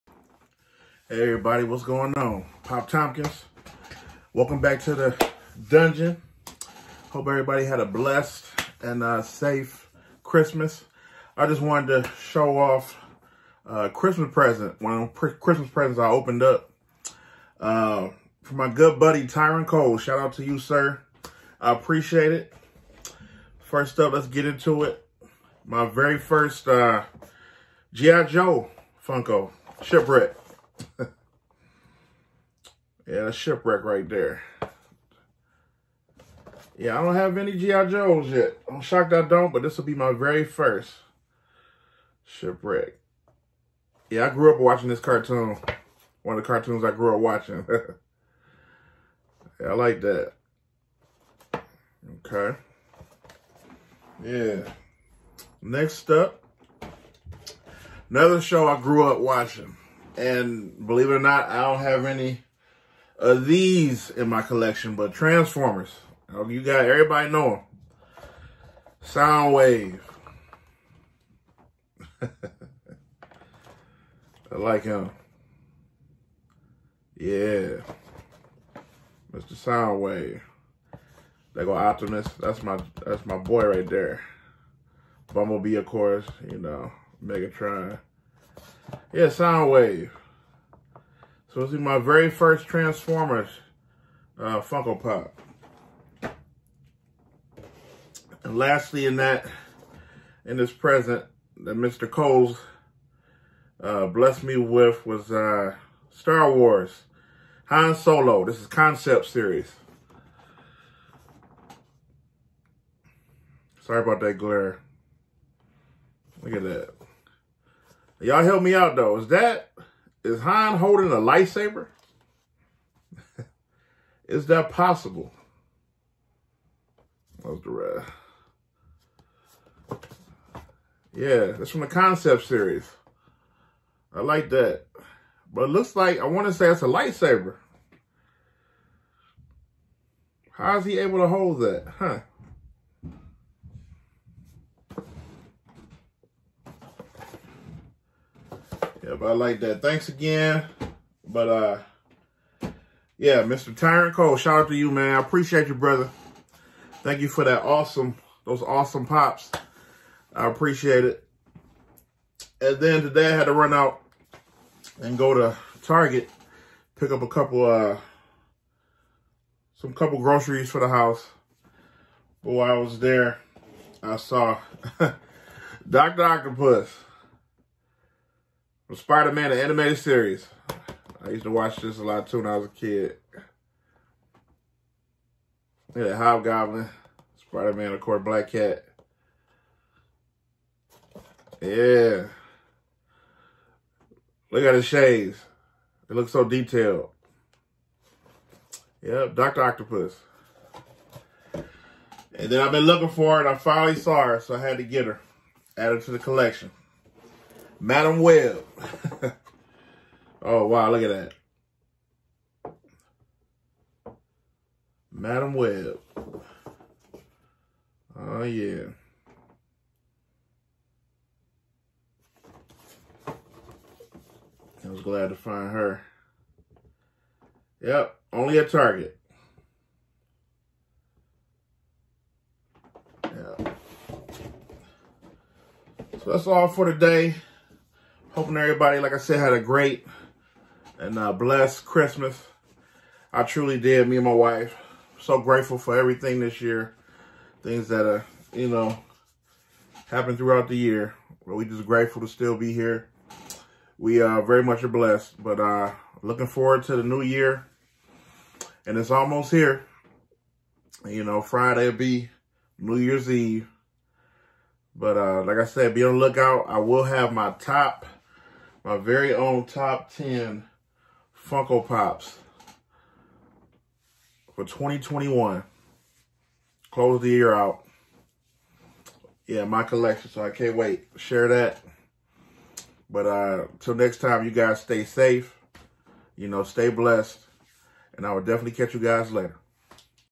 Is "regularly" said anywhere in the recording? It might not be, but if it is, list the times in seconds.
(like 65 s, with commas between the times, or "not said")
not said.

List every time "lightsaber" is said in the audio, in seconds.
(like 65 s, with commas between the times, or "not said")
121 s, 136 s.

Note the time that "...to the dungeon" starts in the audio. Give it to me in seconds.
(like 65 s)
4 s.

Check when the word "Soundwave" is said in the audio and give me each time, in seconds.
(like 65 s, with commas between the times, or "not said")
69 s, 79 s, 89 s.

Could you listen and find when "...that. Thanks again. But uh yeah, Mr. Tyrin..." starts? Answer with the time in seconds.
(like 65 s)
149 s.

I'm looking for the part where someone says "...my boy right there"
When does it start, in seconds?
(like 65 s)
83 s.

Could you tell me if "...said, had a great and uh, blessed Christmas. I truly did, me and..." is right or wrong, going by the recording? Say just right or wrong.
right.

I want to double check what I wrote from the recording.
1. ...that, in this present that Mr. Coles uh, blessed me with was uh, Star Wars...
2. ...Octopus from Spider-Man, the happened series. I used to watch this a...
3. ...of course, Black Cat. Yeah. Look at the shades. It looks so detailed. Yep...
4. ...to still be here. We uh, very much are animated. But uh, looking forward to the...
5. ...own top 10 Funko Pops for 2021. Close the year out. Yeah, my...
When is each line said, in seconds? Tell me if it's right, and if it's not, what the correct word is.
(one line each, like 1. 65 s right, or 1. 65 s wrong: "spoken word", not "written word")
1. 99 s right
2. 176 s wrong: "animated", not "happened"
3. 187 s right
4. 252 s wrong: "blessed", not "animated"
5. 269 s right.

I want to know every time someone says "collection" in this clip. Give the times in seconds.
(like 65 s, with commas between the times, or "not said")
64 s, 206 s, 279 s.